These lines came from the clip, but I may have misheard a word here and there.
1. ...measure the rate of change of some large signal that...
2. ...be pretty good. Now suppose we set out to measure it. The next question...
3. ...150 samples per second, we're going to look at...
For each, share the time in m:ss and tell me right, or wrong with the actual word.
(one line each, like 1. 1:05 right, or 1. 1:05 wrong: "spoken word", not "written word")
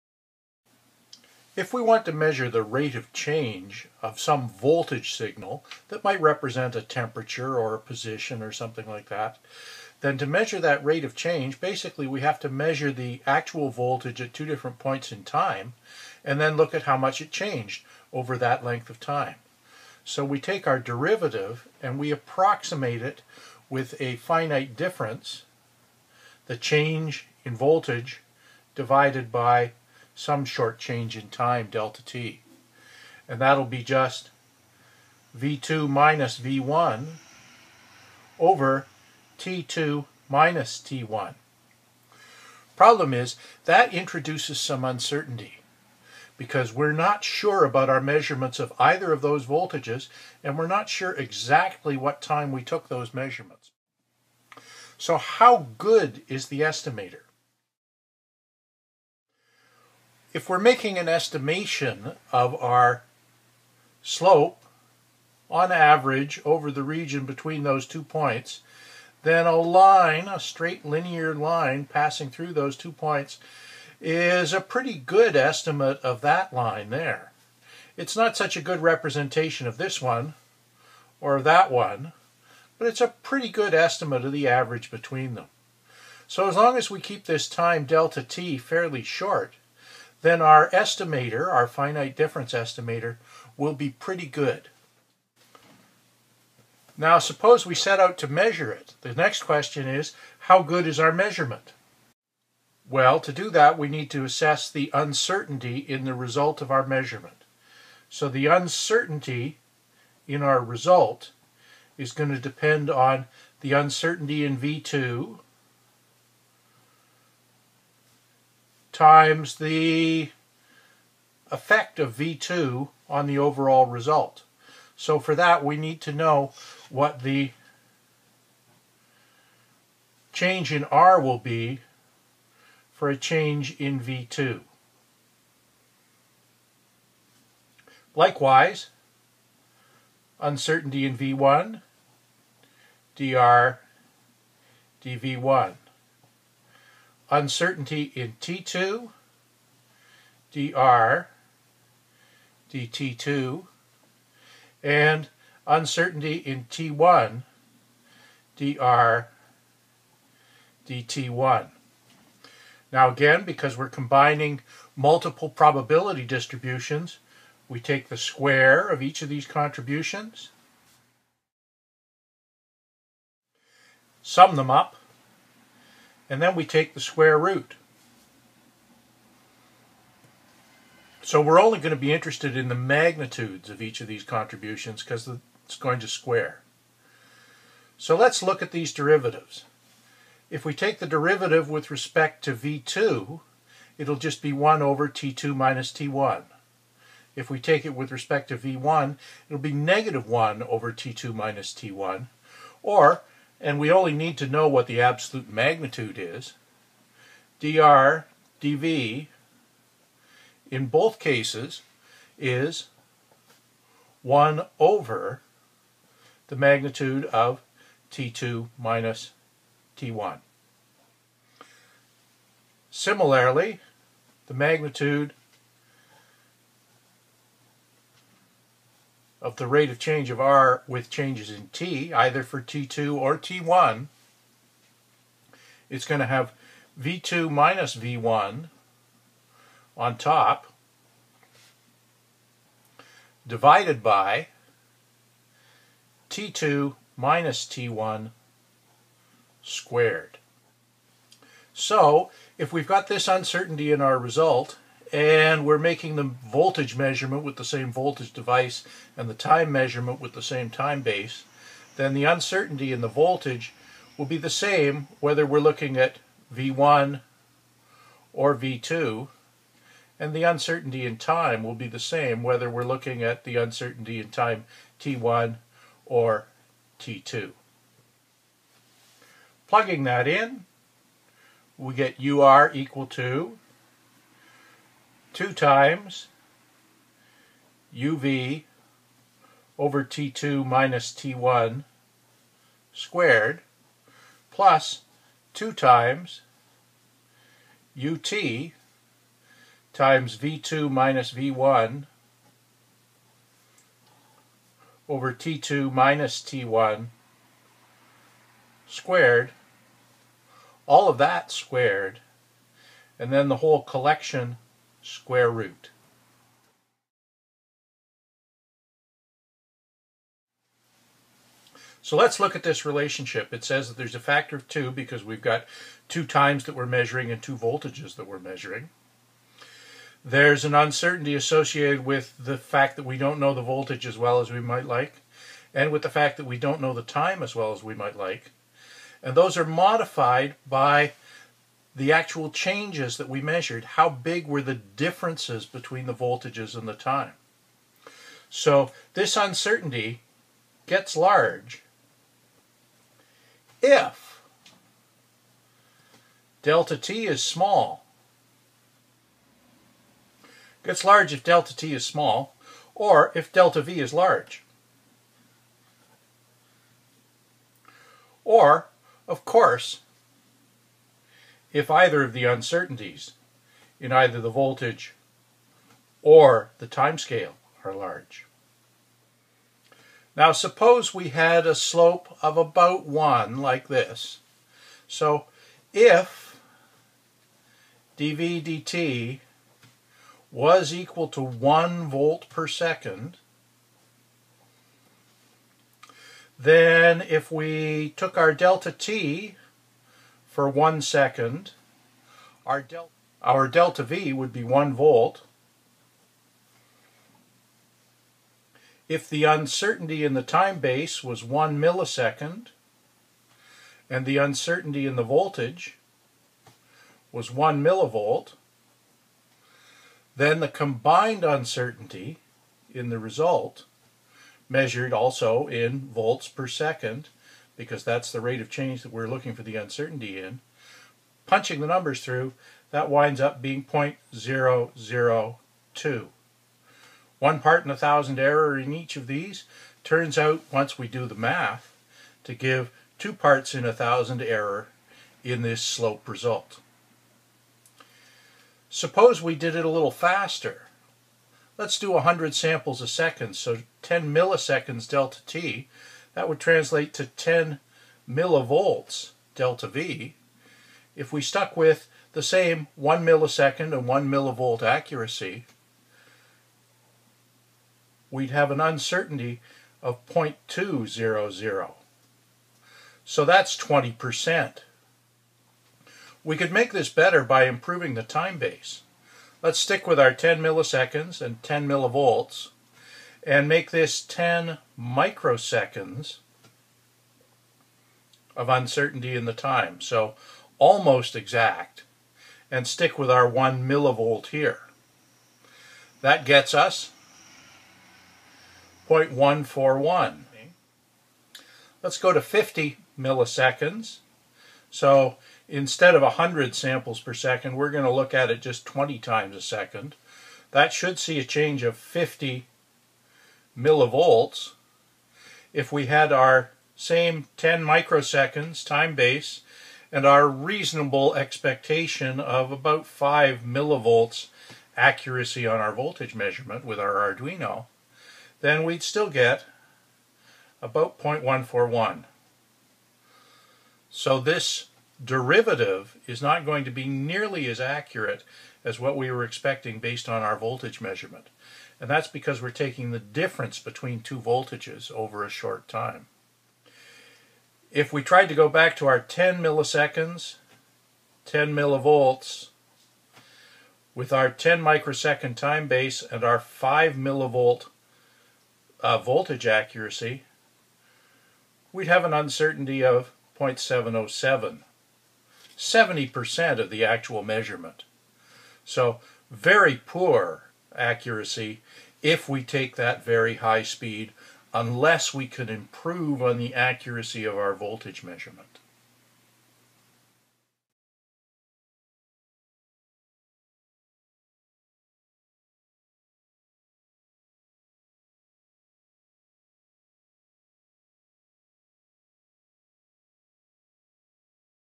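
1. 0:02 wrong: "voltage", not "large"
2. 1:33 right
3. 8:26 wrong: "100", not "150".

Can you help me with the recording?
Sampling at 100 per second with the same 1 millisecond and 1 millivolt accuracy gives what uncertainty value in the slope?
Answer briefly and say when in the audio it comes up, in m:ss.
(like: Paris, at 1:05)
0.200, at 7:50.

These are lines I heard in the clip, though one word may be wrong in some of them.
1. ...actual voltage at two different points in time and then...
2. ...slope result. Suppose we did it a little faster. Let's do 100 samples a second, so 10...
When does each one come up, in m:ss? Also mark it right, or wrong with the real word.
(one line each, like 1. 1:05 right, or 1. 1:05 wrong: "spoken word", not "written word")
1. 0:13 right
2. 7:25 right.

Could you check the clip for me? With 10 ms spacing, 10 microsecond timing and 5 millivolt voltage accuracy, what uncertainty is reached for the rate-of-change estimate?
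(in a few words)
0.707.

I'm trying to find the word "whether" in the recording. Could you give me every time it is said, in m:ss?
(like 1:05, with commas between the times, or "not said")
4:25, 4:32.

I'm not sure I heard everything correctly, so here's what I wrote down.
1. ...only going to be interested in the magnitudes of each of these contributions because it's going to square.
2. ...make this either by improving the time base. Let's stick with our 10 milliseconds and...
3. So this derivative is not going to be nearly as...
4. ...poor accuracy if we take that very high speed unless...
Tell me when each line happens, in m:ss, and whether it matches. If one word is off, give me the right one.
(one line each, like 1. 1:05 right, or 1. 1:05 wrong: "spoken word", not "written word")
1. 3:01 right
2. 7:56 wrong: "better", not "either"
3. 8:54 right
4. 9:30 right.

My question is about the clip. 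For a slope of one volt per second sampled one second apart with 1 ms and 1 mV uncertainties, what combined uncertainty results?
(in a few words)
0.002.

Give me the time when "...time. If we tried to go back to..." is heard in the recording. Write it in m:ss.
9:05.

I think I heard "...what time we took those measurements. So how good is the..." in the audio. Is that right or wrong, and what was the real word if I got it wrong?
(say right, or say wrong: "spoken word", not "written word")
right.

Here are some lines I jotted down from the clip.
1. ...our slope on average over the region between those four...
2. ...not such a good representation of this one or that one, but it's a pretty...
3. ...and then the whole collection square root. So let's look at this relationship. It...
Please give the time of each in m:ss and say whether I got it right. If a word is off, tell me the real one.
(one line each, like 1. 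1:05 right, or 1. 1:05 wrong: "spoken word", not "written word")
1. 1:02 wrong: "two", not "four"
2. 1:18 right
3. 5:13 right.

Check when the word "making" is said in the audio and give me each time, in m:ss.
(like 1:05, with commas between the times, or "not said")
1:00, 4:15.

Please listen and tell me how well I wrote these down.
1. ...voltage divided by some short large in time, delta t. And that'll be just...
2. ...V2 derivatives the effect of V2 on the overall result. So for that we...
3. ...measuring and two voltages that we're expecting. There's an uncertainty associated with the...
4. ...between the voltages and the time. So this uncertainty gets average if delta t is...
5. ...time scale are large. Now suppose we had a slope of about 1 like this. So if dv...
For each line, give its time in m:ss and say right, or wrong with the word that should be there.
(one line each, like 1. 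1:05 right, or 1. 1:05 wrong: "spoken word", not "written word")
1. 0:27 wrong: "change", not "large"
2. 1:54 wrong: "times", not "derivatives"
3. 5:26 wrong: "measuring", not "expecting"
4. 5:45 wrong: "large", not "average"
5. 6:16 right.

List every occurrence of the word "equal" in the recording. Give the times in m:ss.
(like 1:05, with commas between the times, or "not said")
4:42, 6:30.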